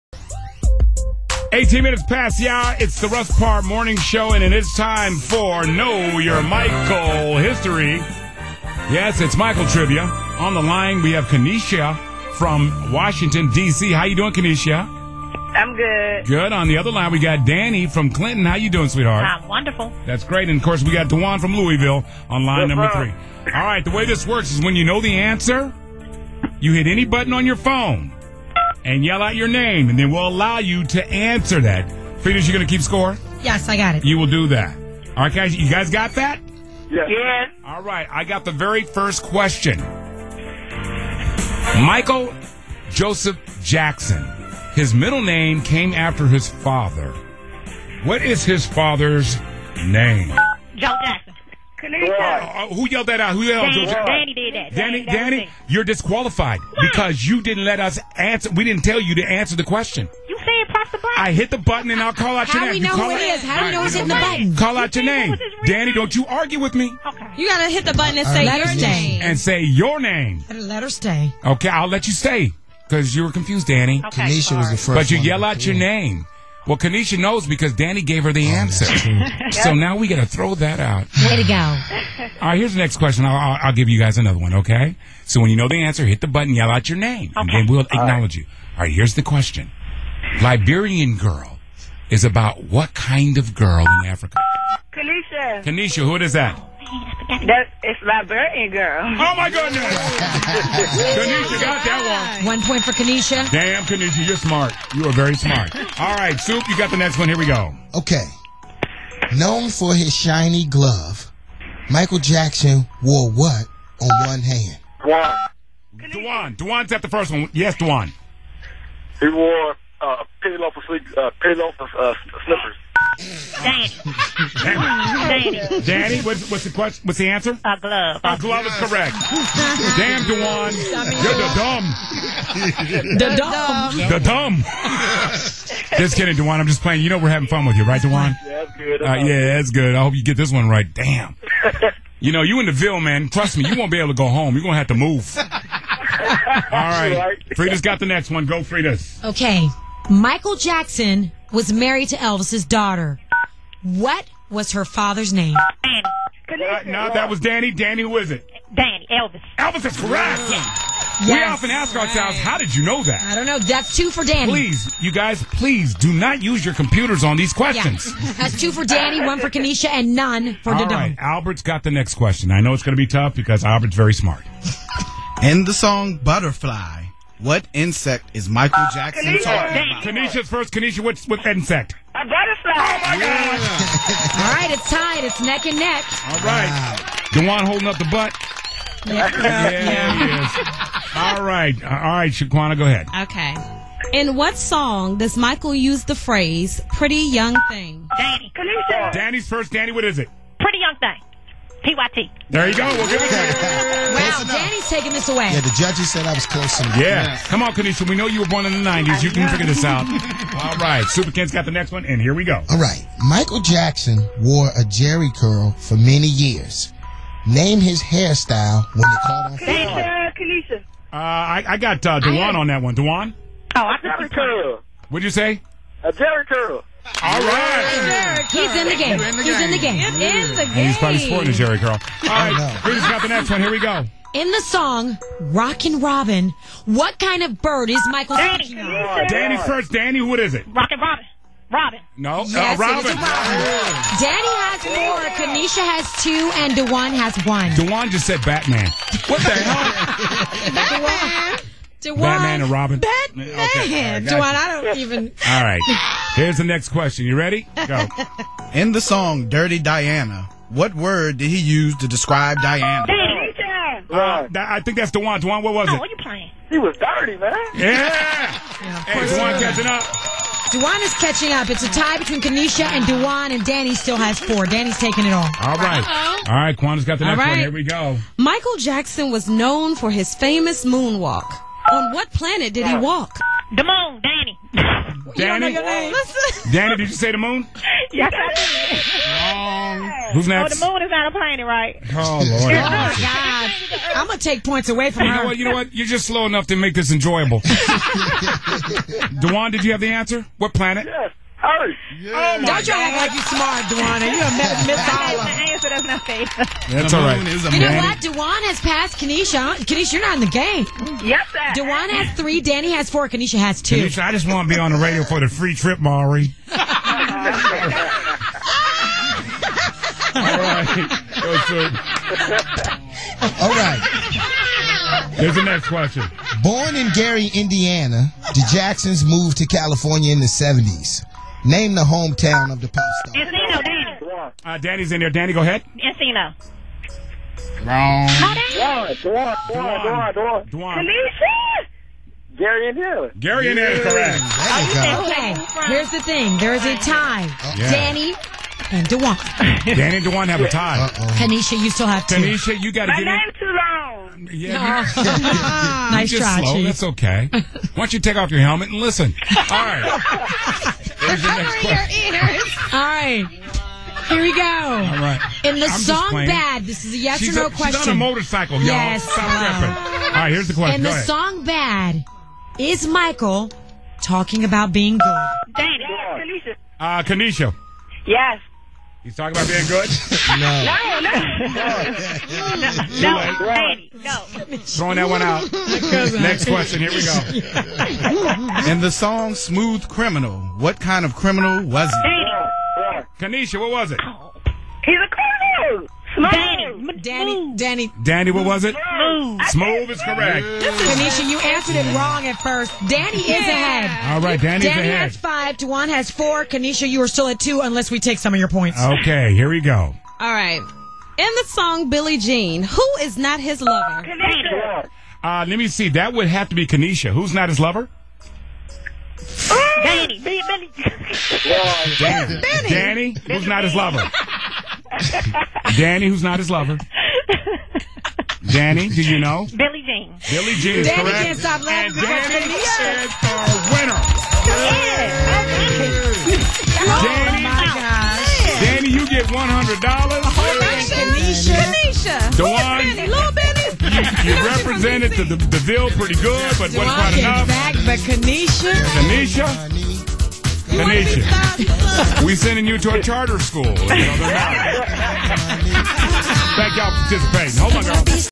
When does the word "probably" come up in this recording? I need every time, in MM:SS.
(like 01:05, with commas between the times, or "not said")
03:50.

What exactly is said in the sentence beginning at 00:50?
Joe Jackson who yelled that out?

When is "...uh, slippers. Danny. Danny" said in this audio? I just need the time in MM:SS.
02:01.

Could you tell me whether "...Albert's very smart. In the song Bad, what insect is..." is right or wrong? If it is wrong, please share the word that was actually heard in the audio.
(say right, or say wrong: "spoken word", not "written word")
wrong: "Butterfly", not "Bad".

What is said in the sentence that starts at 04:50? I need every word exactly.
Oh, the moon is not a planet, right?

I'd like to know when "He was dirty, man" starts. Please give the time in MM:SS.
04:26.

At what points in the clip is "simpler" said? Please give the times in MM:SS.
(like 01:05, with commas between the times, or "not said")
not said.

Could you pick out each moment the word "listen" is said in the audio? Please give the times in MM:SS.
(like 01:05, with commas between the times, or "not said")
05:58.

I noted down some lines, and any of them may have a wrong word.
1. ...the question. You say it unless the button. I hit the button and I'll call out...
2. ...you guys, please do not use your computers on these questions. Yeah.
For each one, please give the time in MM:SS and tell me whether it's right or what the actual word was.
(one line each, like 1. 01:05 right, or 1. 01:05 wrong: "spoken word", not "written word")
1. 00:59 wrong: "press", not "unless"
2. 02:45 right.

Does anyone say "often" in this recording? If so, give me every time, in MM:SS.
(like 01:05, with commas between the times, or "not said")
02:41.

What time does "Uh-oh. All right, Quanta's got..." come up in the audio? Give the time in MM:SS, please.
04:36.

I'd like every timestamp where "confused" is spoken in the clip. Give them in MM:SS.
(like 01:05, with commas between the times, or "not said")
01:13.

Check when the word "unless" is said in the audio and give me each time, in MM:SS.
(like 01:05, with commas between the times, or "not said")
06:47.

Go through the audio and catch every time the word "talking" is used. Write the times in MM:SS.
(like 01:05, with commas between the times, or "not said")
02:59, 06:14, 06:19.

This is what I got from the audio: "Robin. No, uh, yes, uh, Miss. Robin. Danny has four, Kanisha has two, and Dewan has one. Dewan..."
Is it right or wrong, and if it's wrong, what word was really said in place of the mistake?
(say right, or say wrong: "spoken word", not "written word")
wrong: "Robin", not "Miss".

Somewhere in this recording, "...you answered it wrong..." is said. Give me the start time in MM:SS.
06:41.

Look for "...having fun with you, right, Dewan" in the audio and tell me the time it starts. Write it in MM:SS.
02:17.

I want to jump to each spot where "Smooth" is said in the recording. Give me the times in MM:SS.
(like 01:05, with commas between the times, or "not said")
06:29, 06:39.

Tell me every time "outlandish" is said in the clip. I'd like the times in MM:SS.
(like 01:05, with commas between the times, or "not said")
not said.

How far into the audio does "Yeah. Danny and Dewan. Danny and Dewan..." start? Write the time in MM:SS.
05:47.